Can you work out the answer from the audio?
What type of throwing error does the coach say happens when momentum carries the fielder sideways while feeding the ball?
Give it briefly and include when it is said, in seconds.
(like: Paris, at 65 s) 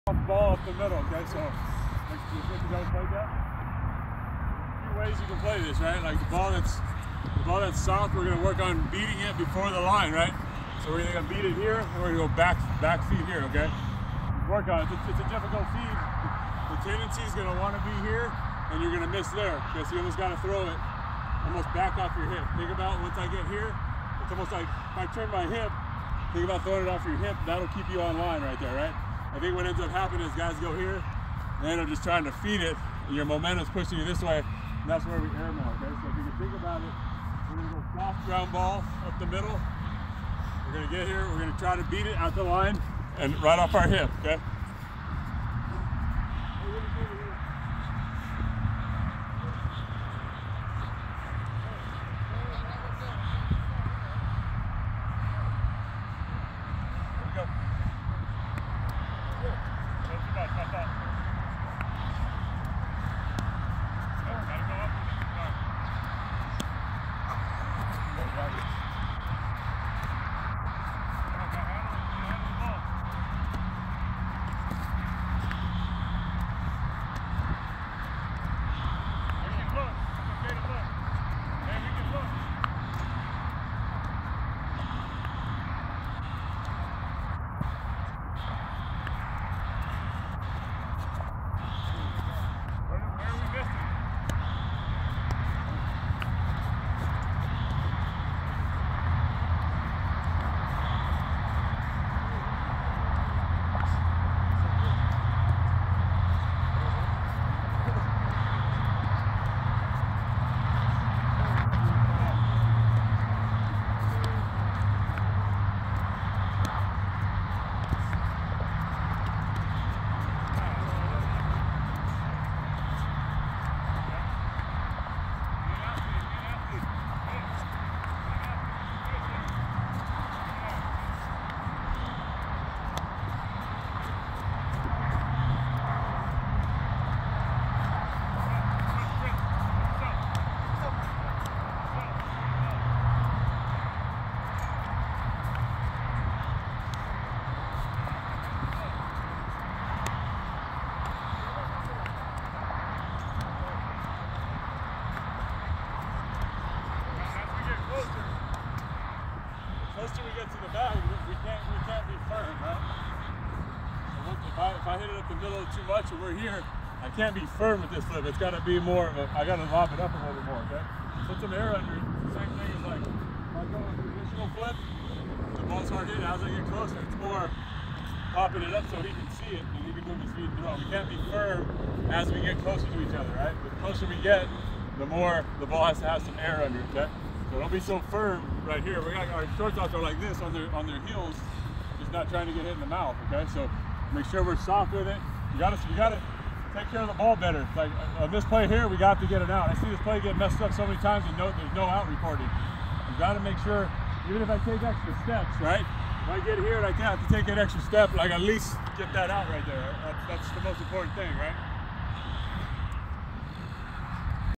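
air mail, at 35 s.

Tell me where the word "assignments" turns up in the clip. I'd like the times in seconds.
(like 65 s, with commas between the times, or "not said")
not said.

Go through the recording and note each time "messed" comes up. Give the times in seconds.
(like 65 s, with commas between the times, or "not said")
200 s.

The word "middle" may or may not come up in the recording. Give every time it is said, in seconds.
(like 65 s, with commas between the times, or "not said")
0 s, 39 s, 165 s.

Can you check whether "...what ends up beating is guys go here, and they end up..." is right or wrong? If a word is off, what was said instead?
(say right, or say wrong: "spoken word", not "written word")
wrong: "happening", not "beating".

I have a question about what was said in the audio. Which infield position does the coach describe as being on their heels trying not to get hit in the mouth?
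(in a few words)
shortstops.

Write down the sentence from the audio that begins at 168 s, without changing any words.
It's got to be more of a, I got to lob it up a little bit more, okay?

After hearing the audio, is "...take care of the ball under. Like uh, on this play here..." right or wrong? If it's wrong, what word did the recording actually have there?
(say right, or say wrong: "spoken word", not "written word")
wrong: "better", not "under".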